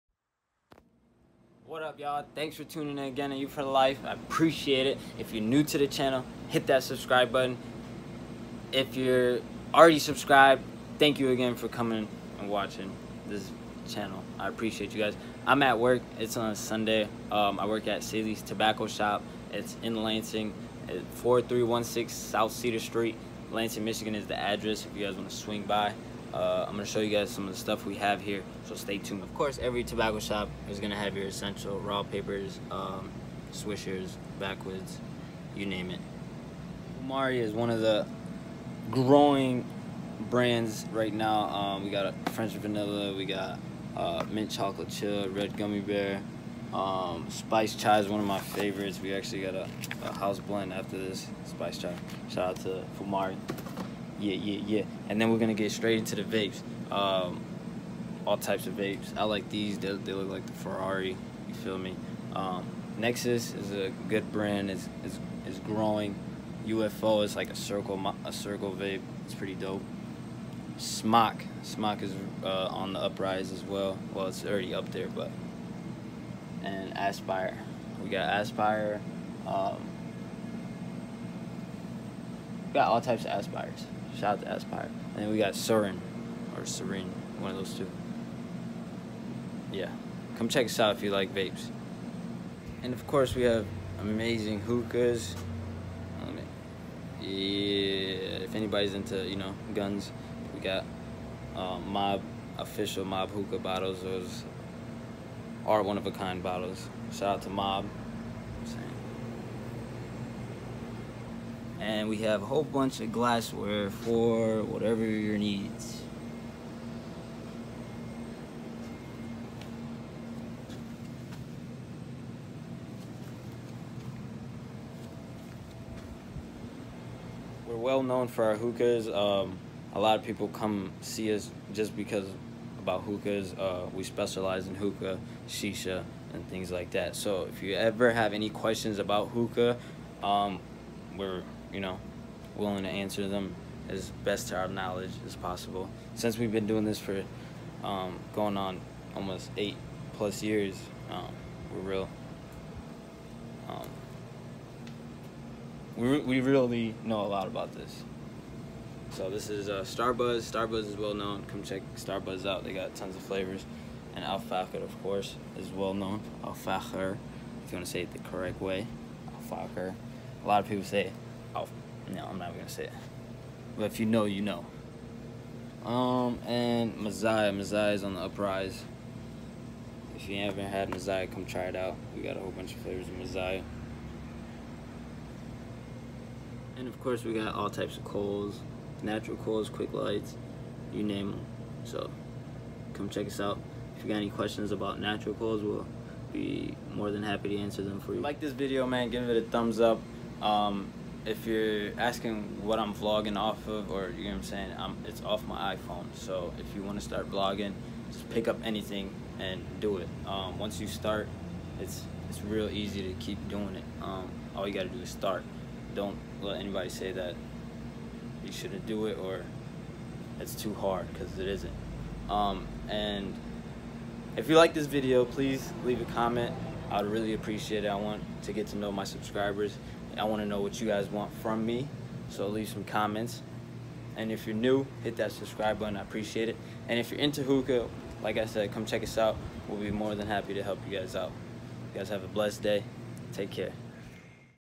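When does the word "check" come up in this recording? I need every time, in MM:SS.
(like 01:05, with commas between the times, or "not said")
01:30, 02:41, 03:13, 03:58.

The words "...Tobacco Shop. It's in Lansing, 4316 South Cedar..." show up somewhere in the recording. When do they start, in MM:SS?
00:18.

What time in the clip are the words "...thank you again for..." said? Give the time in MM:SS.
00:10.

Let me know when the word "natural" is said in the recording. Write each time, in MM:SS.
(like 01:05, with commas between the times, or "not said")
03:09, 03:14.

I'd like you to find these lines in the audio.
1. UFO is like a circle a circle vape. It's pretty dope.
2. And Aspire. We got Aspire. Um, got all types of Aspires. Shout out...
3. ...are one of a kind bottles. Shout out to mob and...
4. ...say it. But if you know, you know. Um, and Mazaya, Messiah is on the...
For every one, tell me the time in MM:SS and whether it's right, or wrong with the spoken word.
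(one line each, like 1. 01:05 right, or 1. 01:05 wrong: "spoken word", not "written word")
1. 01:06 right
2. 01:16 right
3. 01:45 right
4. 02:52 right.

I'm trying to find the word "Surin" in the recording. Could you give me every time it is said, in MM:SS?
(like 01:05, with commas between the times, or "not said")
01:25.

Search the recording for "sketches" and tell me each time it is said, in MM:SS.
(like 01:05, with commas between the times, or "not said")
not said.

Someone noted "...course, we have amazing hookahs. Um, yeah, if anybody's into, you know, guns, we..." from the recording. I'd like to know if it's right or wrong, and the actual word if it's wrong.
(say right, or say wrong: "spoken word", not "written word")
right.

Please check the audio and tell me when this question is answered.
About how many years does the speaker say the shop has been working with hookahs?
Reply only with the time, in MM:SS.
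02:29.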